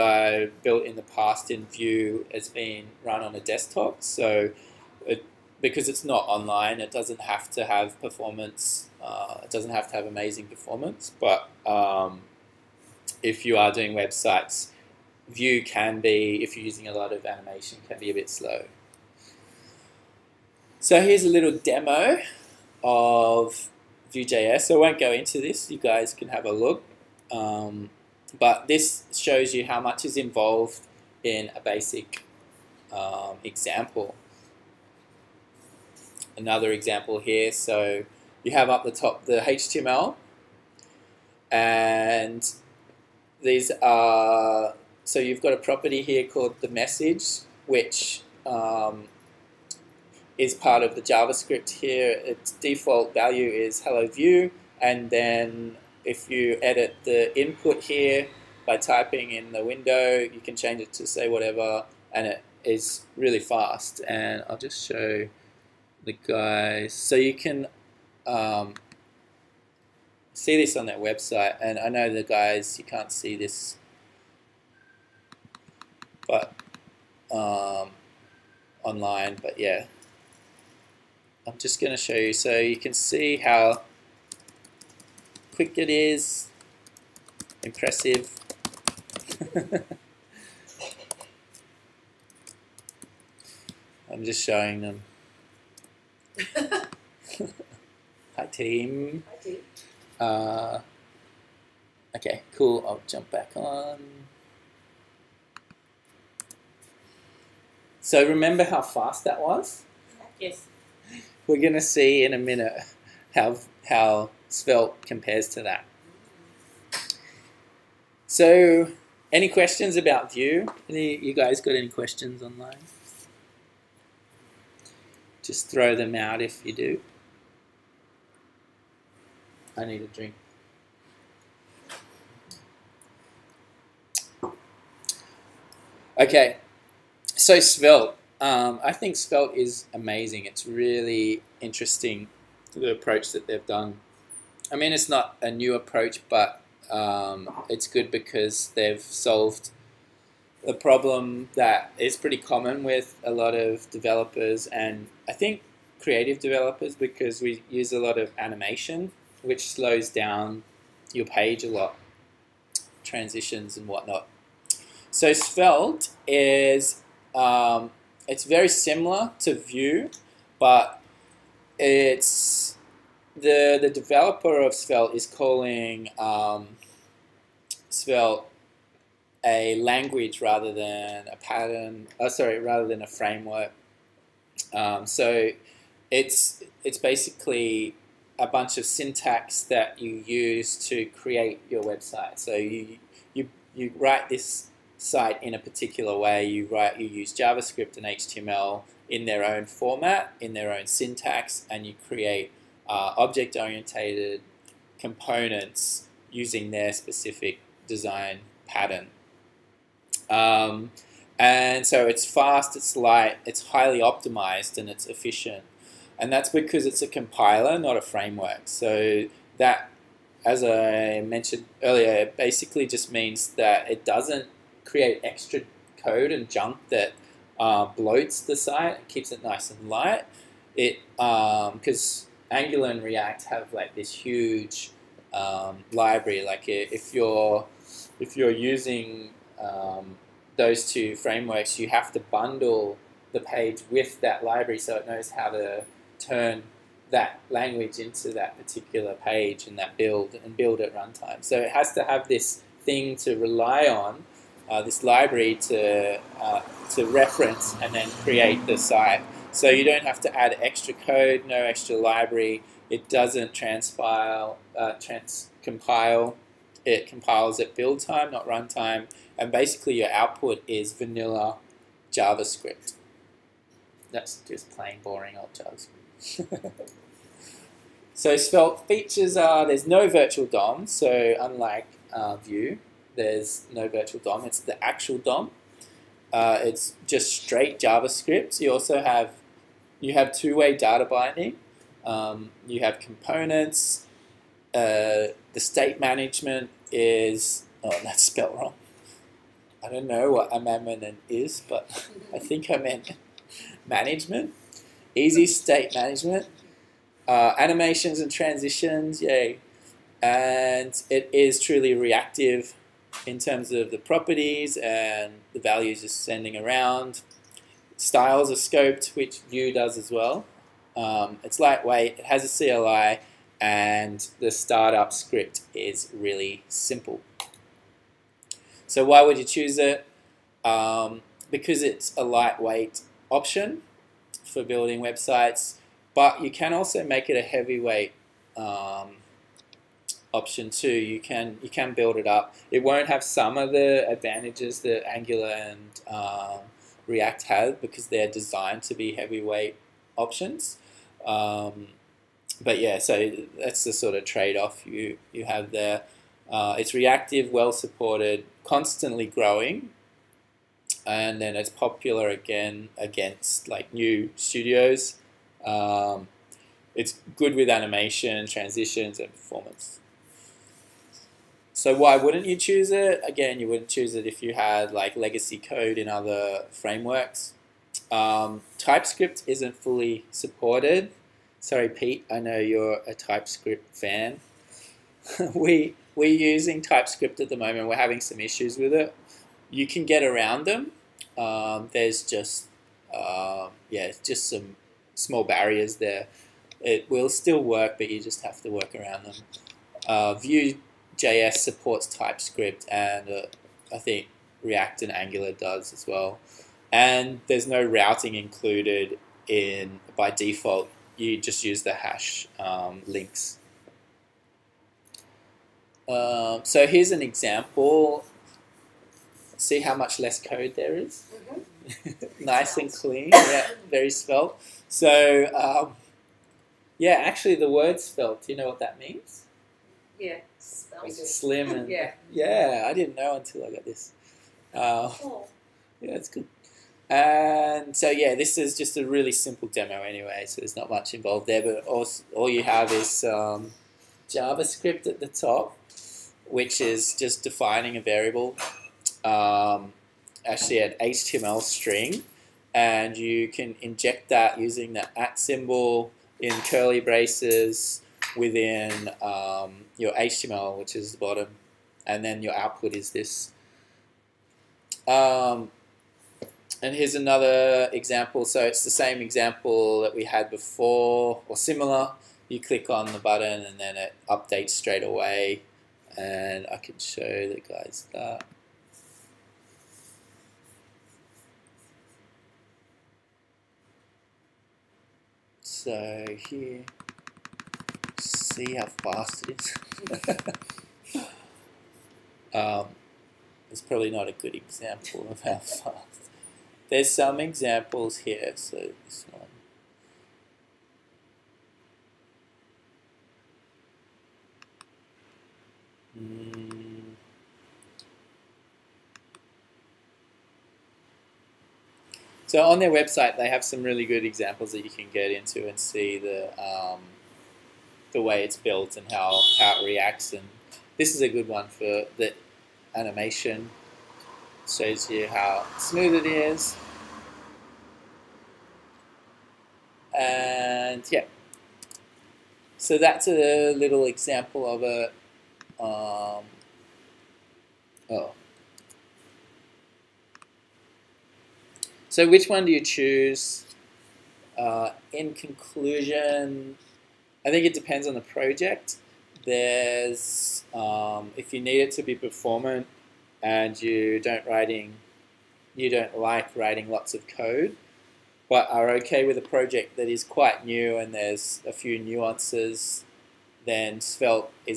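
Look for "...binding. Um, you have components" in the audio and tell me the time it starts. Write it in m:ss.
4:51.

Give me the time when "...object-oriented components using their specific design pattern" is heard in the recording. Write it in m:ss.
3:23.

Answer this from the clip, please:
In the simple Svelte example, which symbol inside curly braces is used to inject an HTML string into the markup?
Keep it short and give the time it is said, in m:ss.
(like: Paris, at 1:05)
at symbol, at 7:35.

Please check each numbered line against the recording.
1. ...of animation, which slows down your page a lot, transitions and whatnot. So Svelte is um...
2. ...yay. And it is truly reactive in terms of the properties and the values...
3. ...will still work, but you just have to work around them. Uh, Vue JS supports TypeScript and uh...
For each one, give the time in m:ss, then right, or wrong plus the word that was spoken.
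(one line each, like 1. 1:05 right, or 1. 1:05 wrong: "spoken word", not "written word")
1. 2:38 right
2. 5:09 right
3. 6:37 right.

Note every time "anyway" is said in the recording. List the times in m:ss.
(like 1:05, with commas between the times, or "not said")
7:20.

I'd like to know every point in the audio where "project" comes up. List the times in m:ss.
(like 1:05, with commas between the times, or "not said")
9:08, 9:19.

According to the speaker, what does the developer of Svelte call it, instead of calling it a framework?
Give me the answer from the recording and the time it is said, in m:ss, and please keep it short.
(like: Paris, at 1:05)
a language, at 2:59.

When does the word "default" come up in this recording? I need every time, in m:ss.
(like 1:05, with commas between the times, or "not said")
0:52, 6:50.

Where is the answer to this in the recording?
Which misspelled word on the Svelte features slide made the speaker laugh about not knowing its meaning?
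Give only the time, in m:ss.
5:00.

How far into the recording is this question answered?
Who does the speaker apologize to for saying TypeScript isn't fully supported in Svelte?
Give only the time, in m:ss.
6:21.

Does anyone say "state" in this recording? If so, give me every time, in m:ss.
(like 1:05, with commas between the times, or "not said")
4:55, 5:05.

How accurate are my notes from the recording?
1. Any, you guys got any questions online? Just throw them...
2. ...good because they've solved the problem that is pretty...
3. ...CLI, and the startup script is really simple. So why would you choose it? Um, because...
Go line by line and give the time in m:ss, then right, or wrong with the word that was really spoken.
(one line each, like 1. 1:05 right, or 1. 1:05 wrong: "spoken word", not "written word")
1. 2:00 right
2. 2:27 right
3. 5:22 right.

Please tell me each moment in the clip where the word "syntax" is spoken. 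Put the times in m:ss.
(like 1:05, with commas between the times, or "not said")
3:08, 3:20.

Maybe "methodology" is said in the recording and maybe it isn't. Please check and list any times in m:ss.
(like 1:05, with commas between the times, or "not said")
not said.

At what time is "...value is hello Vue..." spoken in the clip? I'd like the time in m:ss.
0:53.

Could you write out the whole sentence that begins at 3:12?
So you you you write this site in a particular way.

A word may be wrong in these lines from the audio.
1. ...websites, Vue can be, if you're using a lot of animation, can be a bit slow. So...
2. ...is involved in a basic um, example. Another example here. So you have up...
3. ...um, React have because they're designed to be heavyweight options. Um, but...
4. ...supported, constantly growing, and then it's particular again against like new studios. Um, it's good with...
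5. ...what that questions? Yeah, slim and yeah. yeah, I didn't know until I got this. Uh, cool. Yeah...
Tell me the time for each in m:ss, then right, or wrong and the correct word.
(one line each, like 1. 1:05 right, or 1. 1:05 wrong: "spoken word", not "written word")
1. 0:13 right
2. 0:30 right
3. 5:46 right
4. 5:57 wrong: "popular", not "particular"
5. 7:08 wrong: "means", not "questions".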